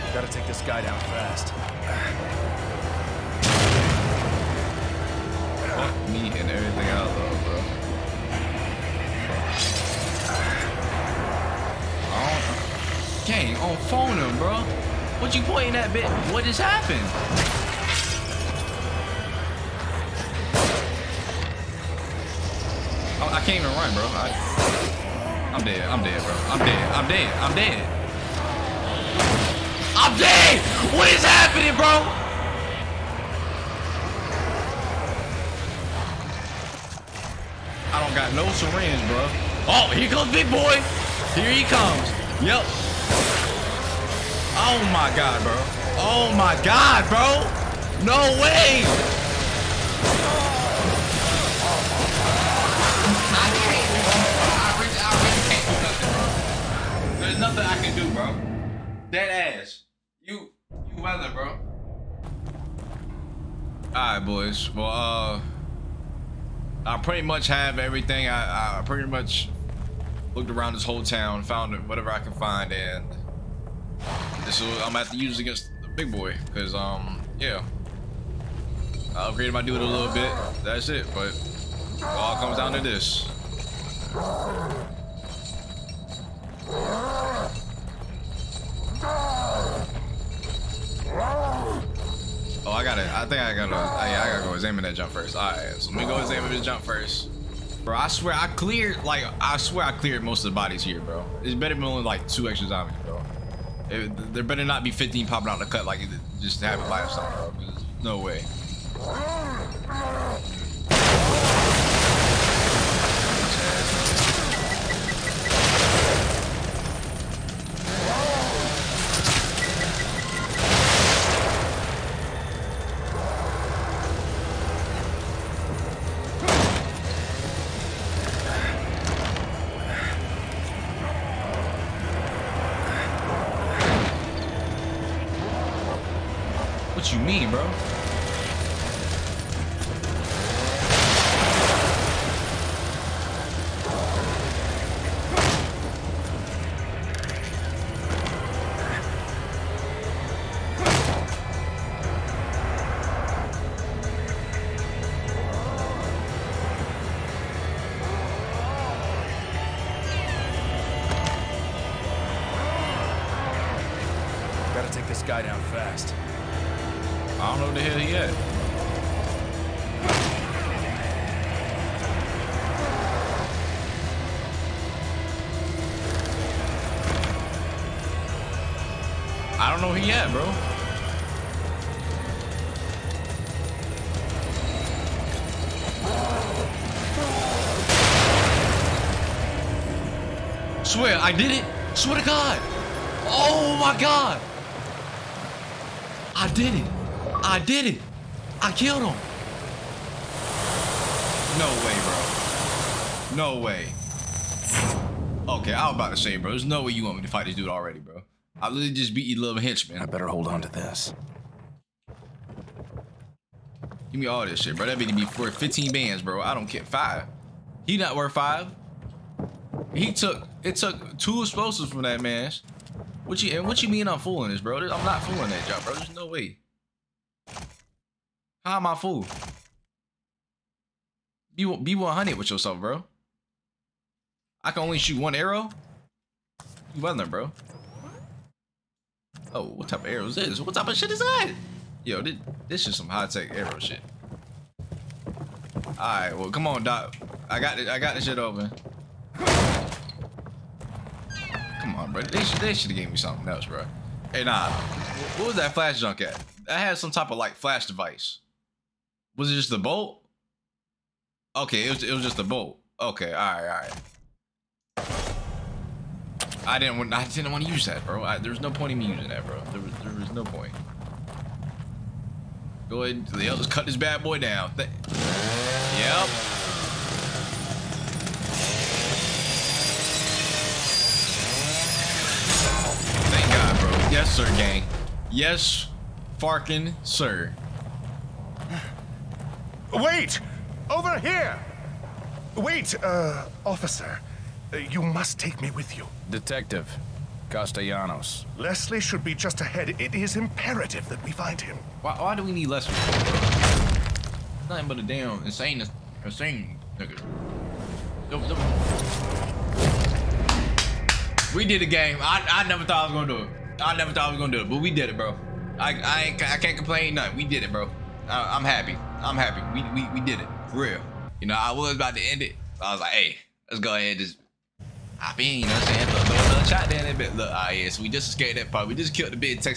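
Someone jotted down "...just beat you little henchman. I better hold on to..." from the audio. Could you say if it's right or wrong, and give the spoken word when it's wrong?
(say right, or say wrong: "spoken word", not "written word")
right.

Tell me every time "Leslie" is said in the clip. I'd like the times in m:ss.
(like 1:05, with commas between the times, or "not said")
4:58, 5:02.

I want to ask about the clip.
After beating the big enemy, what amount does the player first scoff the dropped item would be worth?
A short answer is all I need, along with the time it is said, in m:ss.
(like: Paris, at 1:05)
15 bands, at 3:35.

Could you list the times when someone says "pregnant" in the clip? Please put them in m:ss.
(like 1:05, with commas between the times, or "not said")
not said.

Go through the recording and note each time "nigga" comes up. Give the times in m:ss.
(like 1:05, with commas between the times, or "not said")
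5:06.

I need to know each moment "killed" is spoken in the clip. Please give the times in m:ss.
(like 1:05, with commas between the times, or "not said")
3:18, 5:29.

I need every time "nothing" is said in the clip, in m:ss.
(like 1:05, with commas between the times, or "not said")
0:57, 5:04, 5:17.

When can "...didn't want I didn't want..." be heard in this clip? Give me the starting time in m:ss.
4:26.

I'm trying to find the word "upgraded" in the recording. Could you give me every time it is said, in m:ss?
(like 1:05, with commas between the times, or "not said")
1:19.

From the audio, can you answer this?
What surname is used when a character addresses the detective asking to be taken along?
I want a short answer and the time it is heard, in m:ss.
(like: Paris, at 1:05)
Castellanos, at 4:57.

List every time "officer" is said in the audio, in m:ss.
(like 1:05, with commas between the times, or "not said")
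4:53.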